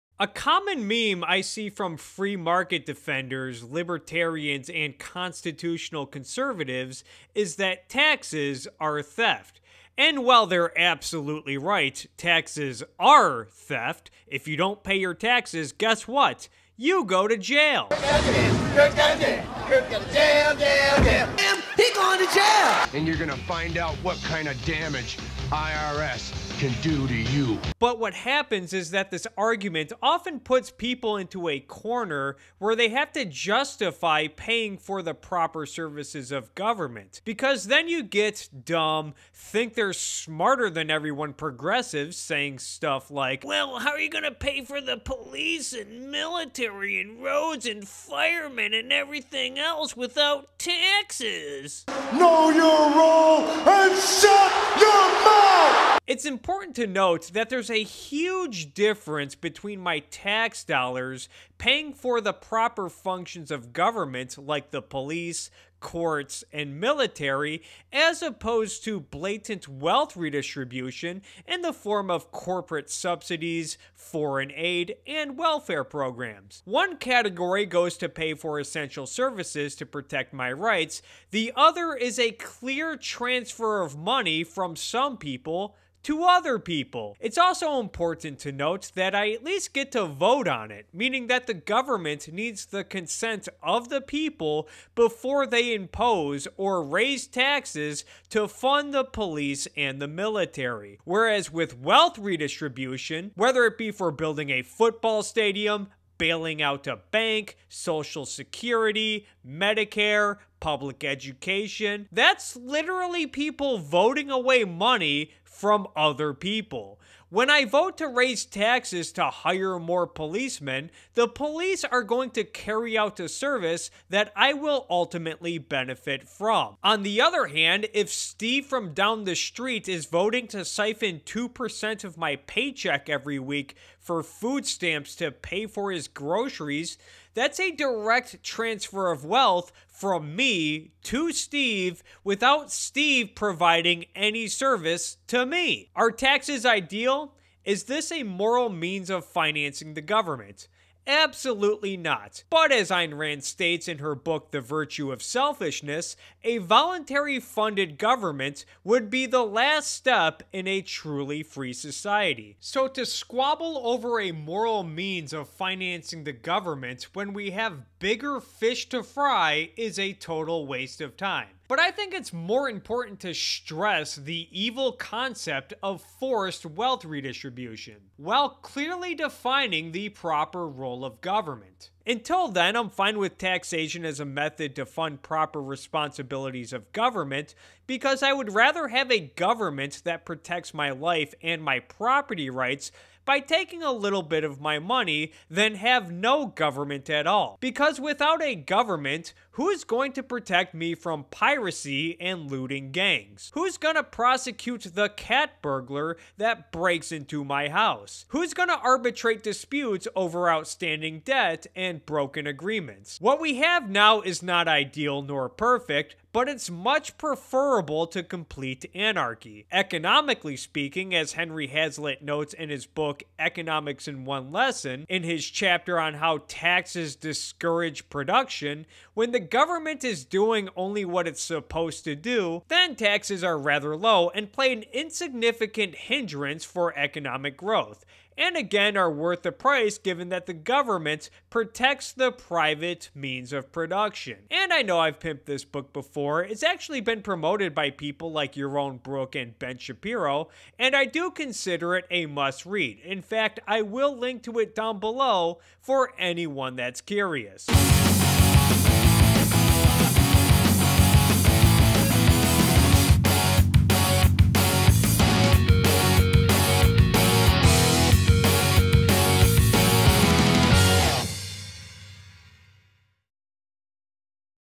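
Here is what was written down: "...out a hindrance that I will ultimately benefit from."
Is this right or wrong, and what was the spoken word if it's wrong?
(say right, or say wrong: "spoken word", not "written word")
wrong: "service", not "hindrance".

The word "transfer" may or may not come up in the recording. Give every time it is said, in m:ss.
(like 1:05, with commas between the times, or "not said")
1:22, 2:18.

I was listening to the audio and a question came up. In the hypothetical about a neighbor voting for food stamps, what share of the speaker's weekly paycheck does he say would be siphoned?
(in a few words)
2%.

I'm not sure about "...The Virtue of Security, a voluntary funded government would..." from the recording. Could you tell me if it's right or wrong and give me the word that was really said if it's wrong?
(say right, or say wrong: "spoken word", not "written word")
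wrong: "Selfishness", not "Security".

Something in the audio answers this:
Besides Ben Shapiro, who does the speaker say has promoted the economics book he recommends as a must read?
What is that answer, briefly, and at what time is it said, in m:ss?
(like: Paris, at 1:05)
Yaron Brook, at 4:08.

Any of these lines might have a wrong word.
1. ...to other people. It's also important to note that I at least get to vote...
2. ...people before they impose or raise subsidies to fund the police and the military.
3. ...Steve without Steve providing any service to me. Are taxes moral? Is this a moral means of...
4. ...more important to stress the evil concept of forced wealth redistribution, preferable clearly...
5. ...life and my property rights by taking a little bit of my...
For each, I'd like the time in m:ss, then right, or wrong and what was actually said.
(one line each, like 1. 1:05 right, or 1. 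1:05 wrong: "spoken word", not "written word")
1. 1:26 right
2. 1:34 wrong: "taxes", not "subsidies"
3. 2:21 wrong: "ideal", not "moral"
4. 2:52 wrong: "while", not "preferable"
5. 3:10 right.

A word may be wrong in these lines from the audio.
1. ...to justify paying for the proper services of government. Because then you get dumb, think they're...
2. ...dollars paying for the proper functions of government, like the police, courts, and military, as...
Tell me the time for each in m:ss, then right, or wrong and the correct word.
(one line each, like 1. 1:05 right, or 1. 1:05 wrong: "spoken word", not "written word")
1. 0:33 right
2. 1:00 right.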